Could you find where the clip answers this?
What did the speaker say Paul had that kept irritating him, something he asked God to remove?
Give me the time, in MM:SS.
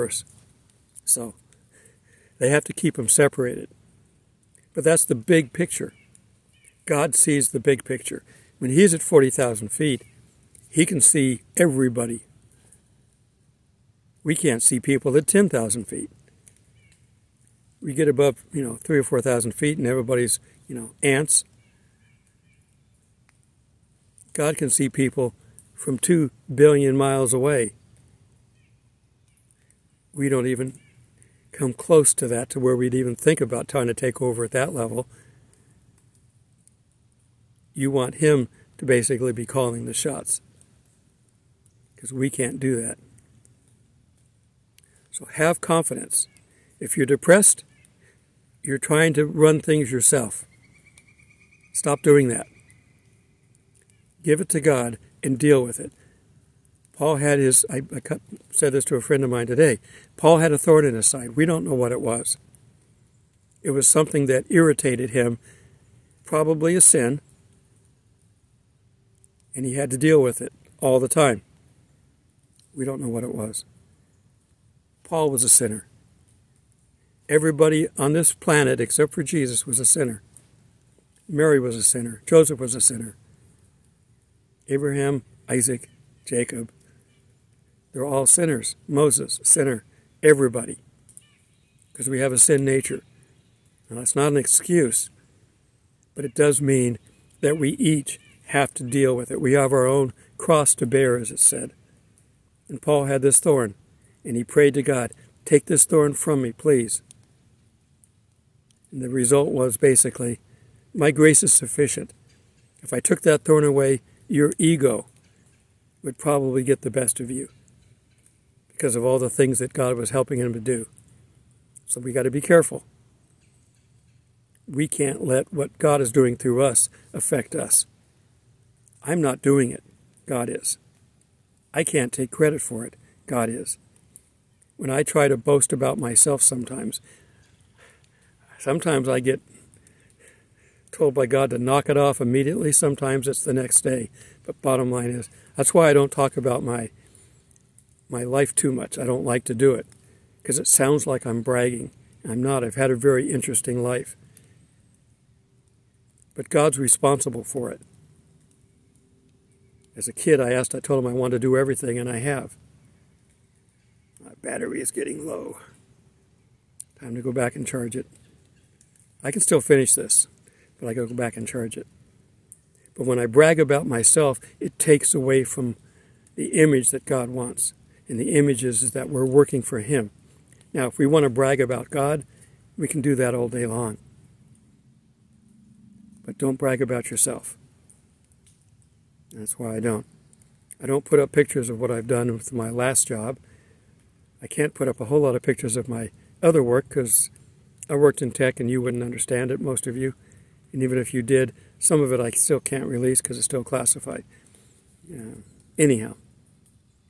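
01:00.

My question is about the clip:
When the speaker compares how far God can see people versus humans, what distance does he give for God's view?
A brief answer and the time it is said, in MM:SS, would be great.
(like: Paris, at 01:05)
2 billion miles, at 00:25.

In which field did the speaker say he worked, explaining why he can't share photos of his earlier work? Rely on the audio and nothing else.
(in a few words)
Tech.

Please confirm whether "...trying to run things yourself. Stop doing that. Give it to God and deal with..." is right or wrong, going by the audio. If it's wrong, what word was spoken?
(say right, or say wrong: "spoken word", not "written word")
right.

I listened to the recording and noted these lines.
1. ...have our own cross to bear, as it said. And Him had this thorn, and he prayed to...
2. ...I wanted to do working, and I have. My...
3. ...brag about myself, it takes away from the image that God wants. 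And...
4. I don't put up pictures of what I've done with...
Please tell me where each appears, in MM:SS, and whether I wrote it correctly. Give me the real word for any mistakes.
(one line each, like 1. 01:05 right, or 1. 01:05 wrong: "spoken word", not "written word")
1. 01:39 wrong: "Paul", not "Him"
2. 02:41 wrong: "everything", not "working"
3. 02:53 right
4. 03:10 right.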